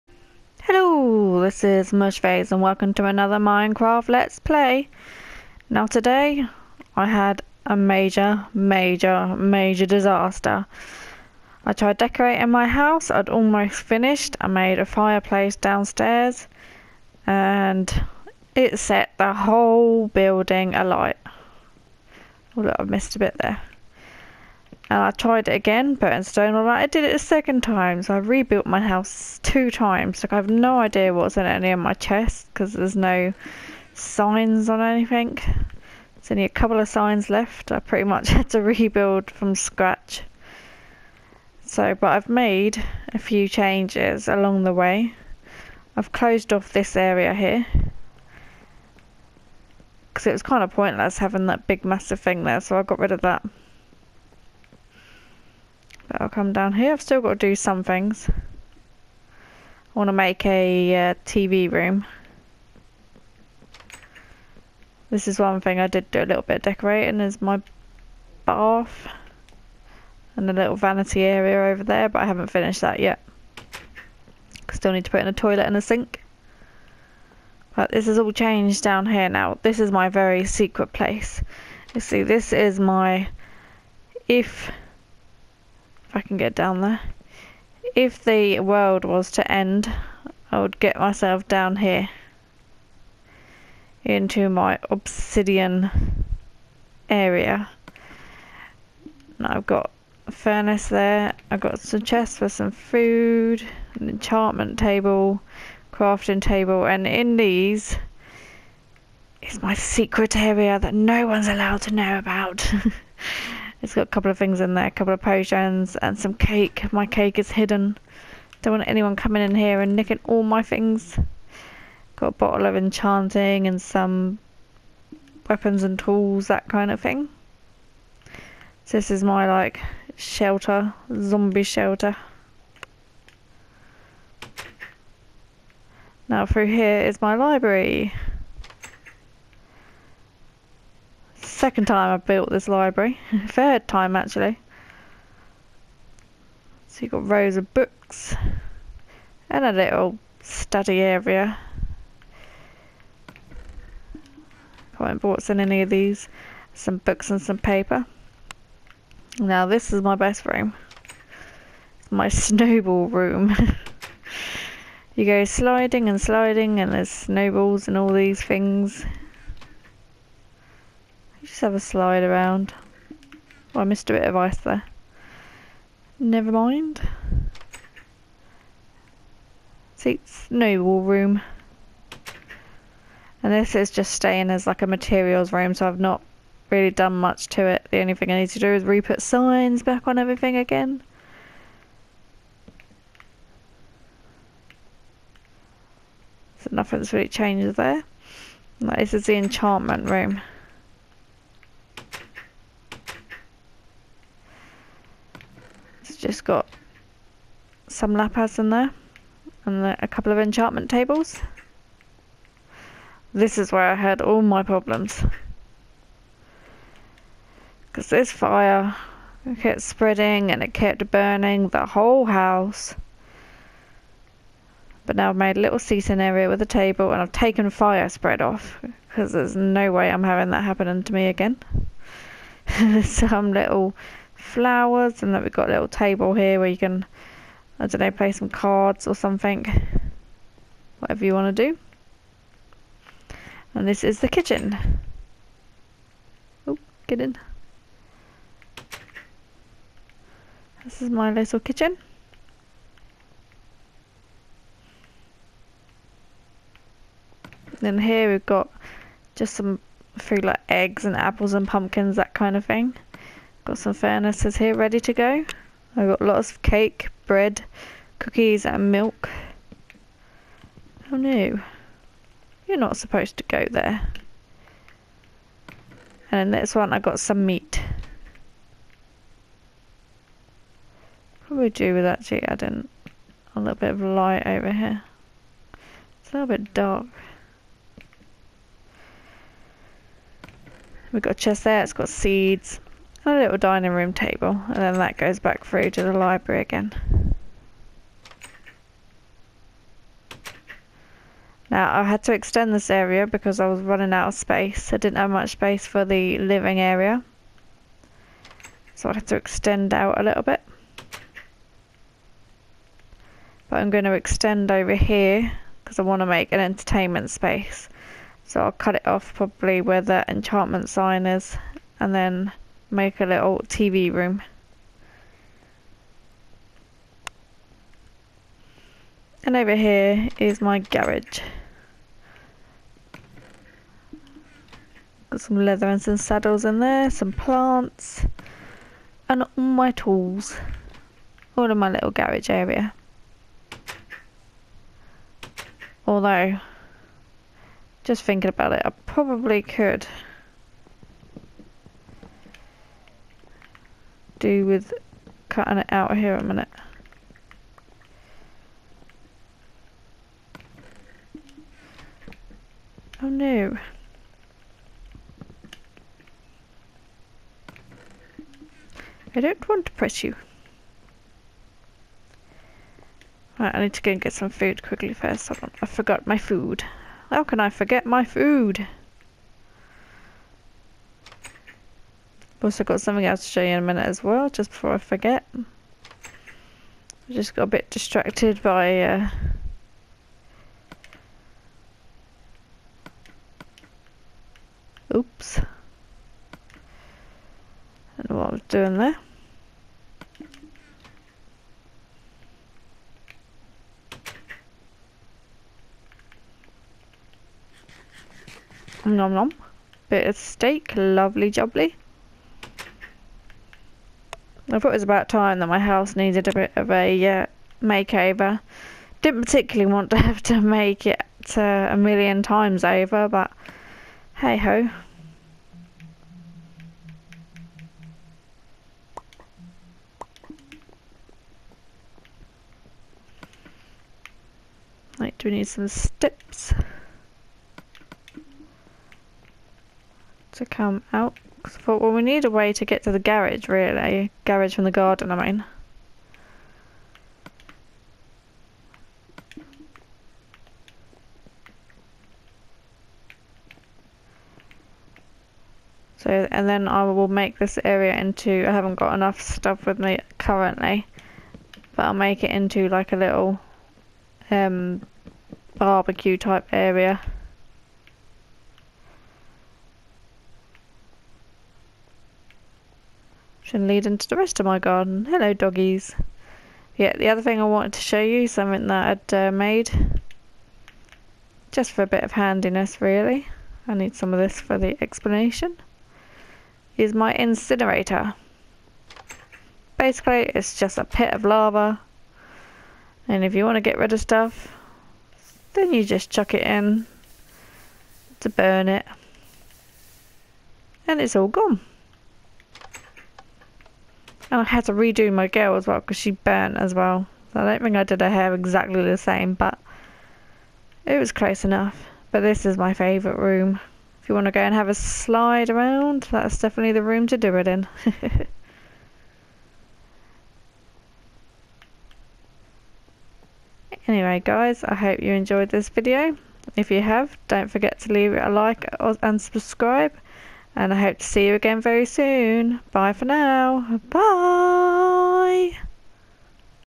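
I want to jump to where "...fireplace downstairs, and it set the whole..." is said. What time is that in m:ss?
0:14.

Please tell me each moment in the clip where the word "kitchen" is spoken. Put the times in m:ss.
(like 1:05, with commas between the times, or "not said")
4:04, 4:11.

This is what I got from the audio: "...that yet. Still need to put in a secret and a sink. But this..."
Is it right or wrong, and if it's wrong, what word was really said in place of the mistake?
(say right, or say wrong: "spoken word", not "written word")
wrong: "toilet", not "secret".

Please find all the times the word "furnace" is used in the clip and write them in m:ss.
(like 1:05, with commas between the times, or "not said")
1:40, 4:23.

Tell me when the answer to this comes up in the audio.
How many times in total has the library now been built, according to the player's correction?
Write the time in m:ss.
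2:23.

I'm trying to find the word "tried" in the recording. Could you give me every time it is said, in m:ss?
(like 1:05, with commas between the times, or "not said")
0:11, 0:25.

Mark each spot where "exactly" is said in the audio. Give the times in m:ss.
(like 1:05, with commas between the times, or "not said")
8:28.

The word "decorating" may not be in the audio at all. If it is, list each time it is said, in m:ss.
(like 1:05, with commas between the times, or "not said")
0:11, 1:06.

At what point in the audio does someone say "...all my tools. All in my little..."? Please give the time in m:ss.
5:39.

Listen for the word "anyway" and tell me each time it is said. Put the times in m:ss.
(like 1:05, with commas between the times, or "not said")
8:44.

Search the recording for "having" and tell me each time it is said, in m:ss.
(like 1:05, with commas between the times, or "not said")
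0:51, 3:50.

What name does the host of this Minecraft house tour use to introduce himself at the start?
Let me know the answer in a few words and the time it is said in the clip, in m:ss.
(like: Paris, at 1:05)
Mushface, at 0:01.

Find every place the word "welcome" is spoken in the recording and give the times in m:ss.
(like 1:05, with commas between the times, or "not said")
0:02.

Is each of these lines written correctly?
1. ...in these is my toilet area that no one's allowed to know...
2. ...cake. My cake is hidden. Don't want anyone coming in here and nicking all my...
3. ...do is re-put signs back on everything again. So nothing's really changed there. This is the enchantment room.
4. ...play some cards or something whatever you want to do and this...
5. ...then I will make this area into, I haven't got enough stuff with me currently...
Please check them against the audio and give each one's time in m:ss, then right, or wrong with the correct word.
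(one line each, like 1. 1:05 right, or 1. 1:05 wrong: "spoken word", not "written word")
1. 1:47 wrong: "secret", not "toilet"
2. 1:56 right
3. 3:08 right
4. 3:58 right
5. 7:36 right.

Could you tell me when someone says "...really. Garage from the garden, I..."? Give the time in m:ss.
7:23.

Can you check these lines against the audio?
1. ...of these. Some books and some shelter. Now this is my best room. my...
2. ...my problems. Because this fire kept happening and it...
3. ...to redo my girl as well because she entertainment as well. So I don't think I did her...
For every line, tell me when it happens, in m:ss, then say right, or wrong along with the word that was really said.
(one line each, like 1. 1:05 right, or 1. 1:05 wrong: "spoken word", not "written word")
1. 2:35 wrong: "paper", not "shelter"
2. 3:34 wrong: "spreading", not "happening"
3. 8:24 wrong: "burnt", not "entertainment".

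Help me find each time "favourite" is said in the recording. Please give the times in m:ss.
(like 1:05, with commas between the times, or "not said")
8:32.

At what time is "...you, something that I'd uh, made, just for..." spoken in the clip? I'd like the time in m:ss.
7:58.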